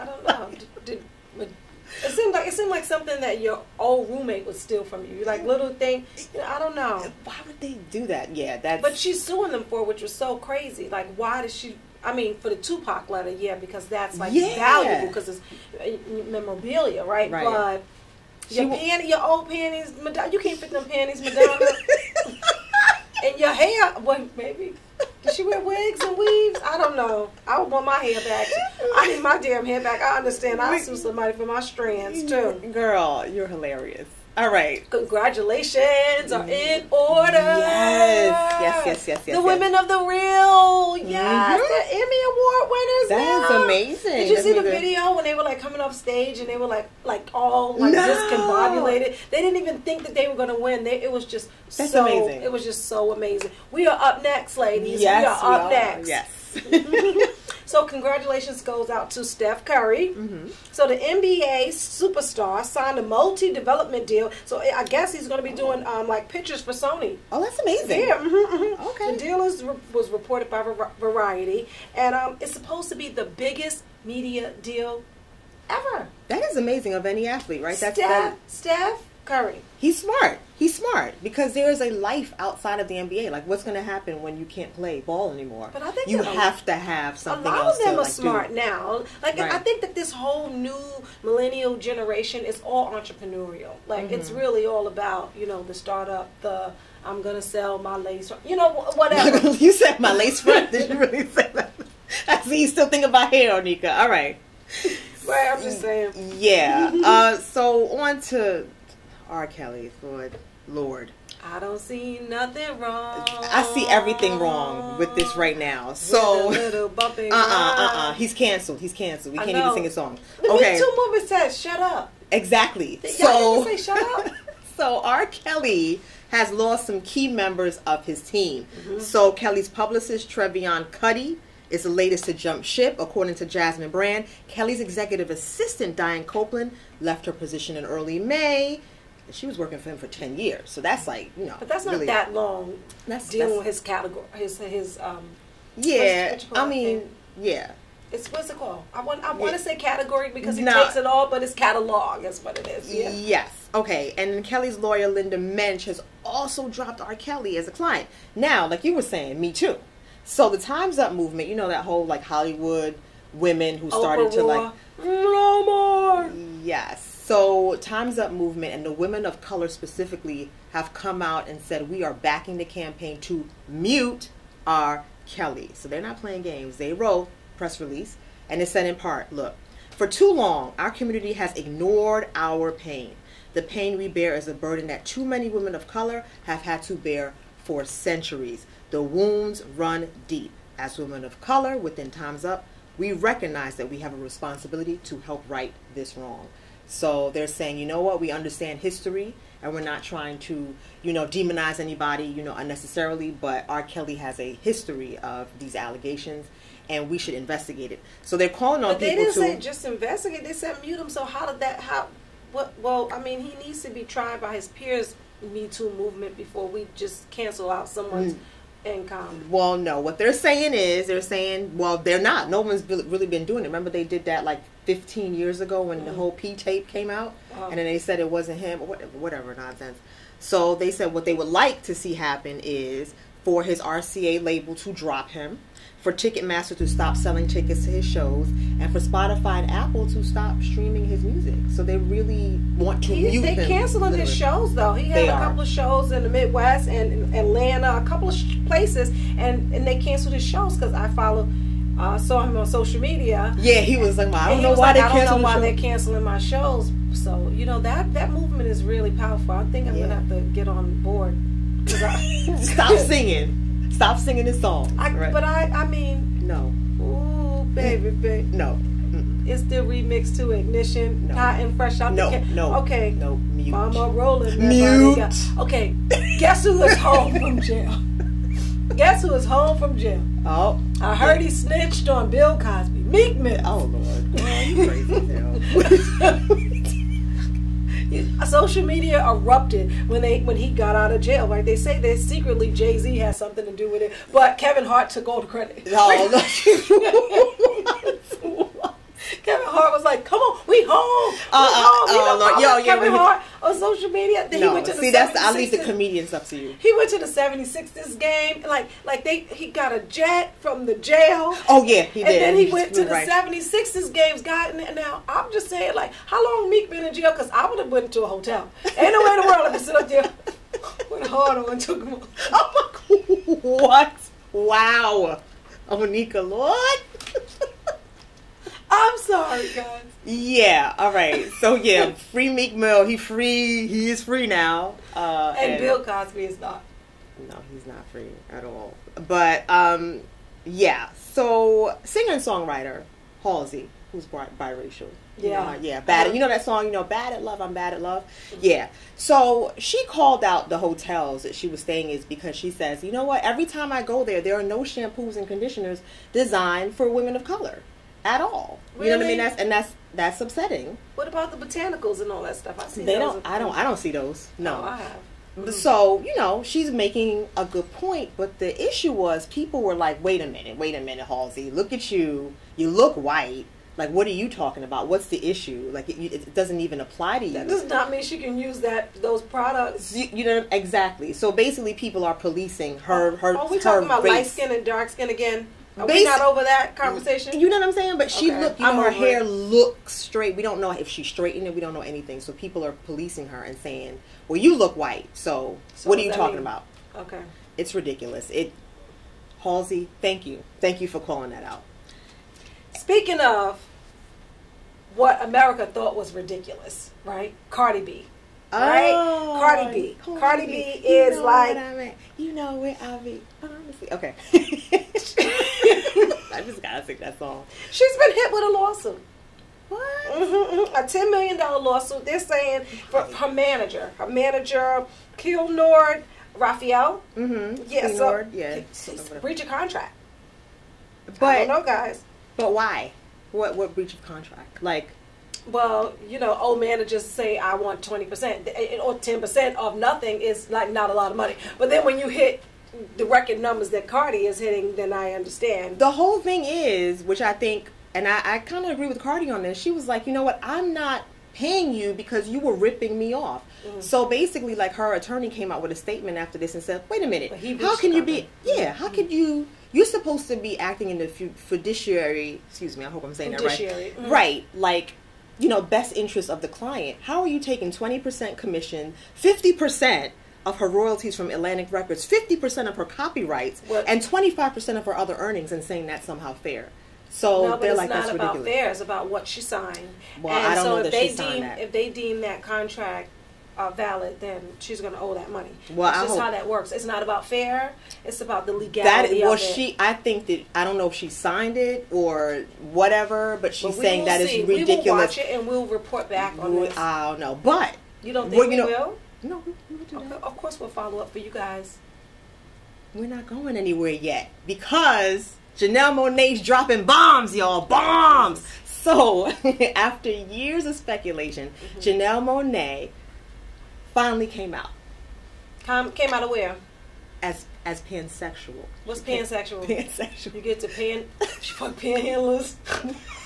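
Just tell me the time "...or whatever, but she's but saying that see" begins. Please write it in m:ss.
8:12.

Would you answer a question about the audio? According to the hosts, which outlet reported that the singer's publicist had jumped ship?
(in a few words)
Jasmine Brand.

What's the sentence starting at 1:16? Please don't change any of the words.
That is amazing of any athlete, right?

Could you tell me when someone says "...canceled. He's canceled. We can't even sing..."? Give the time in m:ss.
1:58.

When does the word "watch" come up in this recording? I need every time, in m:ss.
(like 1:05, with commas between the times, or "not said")
8:15.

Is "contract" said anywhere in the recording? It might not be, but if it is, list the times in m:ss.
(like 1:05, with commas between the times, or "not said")
7:09, 7:14, 8:02.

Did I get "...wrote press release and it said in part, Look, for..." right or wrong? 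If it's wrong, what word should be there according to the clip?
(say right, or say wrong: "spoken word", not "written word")
right.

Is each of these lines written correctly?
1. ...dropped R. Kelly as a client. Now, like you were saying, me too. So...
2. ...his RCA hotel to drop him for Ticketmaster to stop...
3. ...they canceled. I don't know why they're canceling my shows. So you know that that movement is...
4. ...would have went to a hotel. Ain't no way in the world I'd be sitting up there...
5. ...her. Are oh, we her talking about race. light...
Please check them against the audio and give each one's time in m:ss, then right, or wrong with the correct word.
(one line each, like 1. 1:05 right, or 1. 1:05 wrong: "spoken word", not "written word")
1. 2:36 right
2. 3:53 wrong: "label", not "hotel"
3. 4:14 right
4. 5:17 right
5. 6:23 right.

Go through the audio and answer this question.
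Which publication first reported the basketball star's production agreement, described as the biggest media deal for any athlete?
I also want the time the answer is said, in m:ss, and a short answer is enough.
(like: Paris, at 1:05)
Variety, at 1:10.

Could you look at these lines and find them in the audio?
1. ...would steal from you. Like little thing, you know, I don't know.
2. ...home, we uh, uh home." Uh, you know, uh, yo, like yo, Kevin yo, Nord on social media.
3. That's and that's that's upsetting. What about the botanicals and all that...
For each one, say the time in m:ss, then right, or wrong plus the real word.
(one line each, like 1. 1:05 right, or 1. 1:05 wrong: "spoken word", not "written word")
1. 0:04 right
2. 5:00 wrong: "Hart", not "Nord"
3. 5:59 right.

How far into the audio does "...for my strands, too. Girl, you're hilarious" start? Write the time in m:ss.
0:31.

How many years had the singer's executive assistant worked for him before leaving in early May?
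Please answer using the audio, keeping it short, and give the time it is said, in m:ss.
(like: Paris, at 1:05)
10, at 2:20.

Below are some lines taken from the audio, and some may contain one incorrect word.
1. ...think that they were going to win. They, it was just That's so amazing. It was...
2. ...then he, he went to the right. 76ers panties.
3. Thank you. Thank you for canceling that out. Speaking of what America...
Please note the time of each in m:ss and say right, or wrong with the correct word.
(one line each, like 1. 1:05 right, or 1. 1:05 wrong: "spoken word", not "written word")
1. 0:49 right
2. 5:12 wrong: "games", not "panties"
3. 6:40 wrong: "calling", not "canceling".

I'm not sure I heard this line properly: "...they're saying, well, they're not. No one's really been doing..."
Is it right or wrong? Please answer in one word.
right.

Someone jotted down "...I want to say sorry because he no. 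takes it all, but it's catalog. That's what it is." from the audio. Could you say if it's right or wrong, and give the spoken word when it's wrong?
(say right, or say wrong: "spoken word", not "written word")
wrong: "category", not "sorry".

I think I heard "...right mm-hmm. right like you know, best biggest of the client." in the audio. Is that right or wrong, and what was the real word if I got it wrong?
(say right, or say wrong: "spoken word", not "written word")
wrong: "interest", not "biggest".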